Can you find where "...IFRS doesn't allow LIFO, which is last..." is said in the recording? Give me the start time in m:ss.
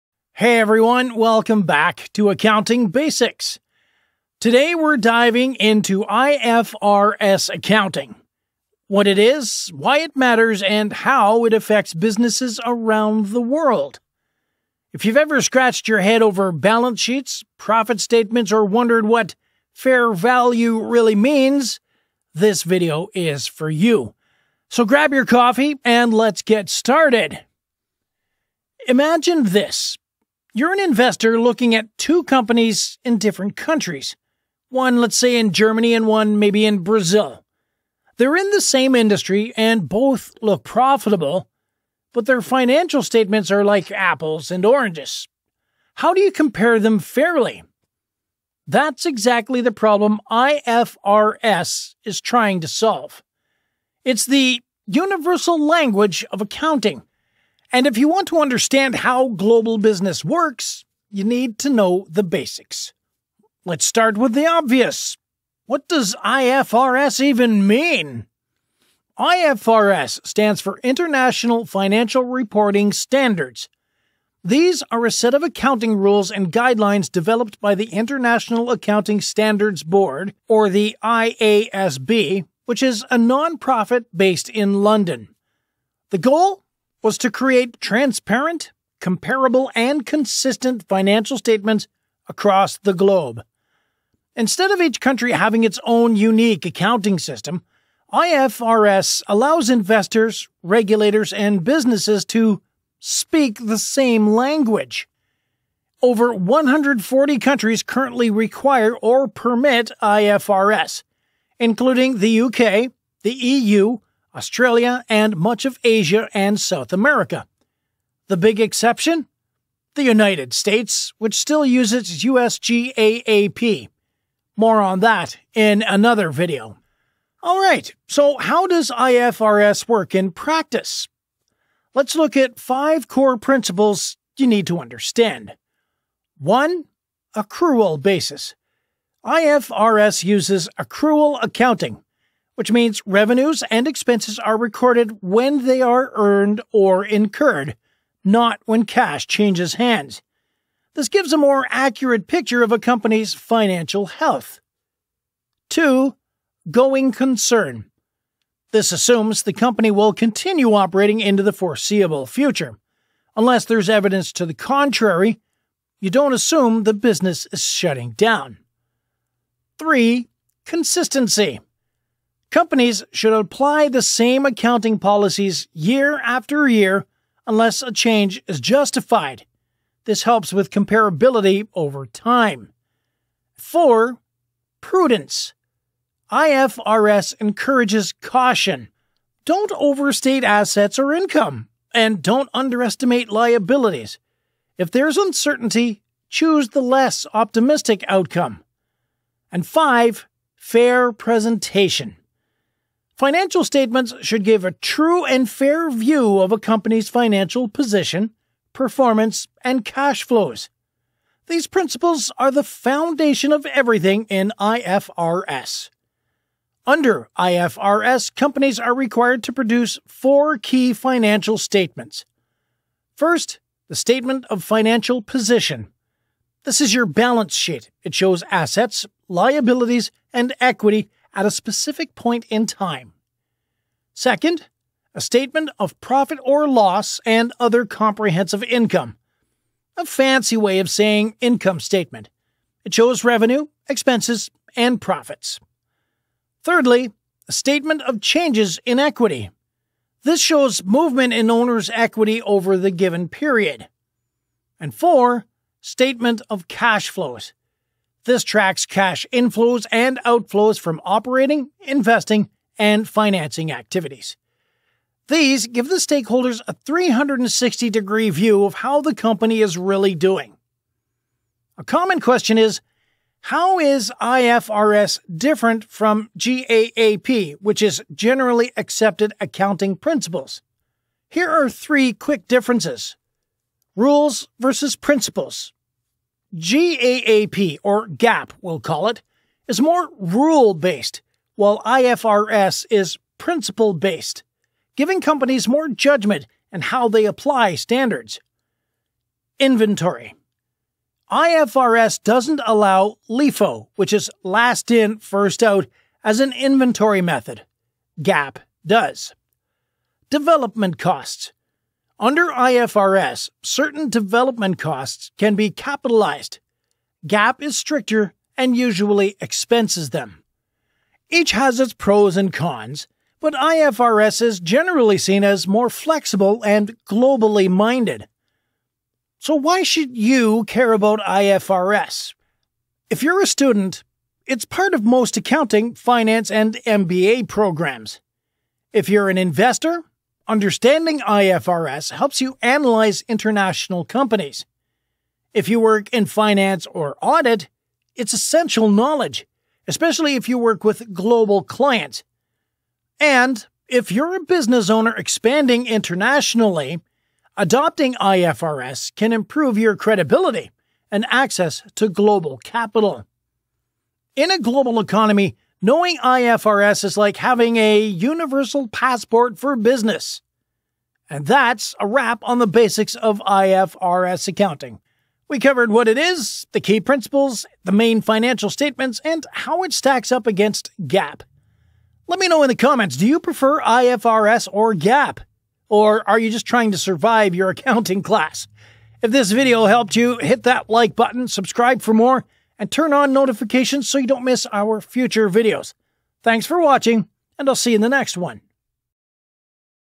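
5:01.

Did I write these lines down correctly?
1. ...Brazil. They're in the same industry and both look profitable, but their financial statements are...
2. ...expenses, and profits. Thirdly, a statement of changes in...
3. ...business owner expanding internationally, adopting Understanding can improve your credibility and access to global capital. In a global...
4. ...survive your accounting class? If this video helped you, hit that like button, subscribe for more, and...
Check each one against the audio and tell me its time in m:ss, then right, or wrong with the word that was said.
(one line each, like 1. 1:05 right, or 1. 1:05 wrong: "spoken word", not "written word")
1. 0:36 right
2. 4:03 right
3. 5:54 wrong: "IFRS", not "Understanding"
4. 6:26 right.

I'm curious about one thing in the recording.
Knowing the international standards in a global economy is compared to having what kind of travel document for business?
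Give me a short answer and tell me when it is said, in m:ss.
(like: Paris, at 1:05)
Universal passport, at 6:08.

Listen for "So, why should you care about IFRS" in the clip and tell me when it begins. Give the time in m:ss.
5:29.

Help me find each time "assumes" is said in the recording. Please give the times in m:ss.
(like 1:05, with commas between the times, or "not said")
2:38, 2:46.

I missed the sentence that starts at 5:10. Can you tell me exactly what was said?
Development costs under IFRS, certain development costs can be capitalized.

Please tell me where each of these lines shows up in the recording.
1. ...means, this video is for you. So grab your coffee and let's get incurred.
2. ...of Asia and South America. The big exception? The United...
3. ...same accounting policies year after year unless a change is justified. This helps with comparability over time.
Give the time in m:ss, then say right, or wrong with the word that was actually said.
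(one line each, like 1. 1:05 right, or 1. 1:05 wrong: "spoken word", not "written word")
1. 0:21 wrong: "started", not "incurred"
2. 1:55 right
3. 2:54 right.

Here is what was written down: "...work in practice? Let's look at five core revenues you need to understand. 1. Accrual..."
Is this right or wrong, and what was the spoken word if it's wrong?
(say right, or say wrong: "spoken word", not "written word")
wrong: "principles", not "revenues".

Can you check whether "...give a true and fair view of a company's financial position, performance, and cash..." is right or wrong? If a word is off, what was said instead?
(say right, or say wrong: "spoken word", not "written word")
right.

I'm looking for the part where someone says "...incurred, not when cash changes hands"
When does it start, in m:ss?
2:27.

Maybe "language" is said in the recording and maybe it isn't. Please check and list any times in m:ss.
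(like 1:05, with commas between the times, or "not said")
0:55, 1:44.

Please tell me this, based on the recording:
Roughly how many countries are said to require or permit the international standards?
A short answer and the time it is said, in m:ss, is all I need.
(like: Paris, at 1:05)
Over 140, at 1:46.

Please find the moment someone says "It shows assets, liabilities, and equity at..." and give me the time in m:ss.
3:48.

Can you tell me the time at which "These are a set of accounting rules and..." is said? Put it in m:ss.
1:14.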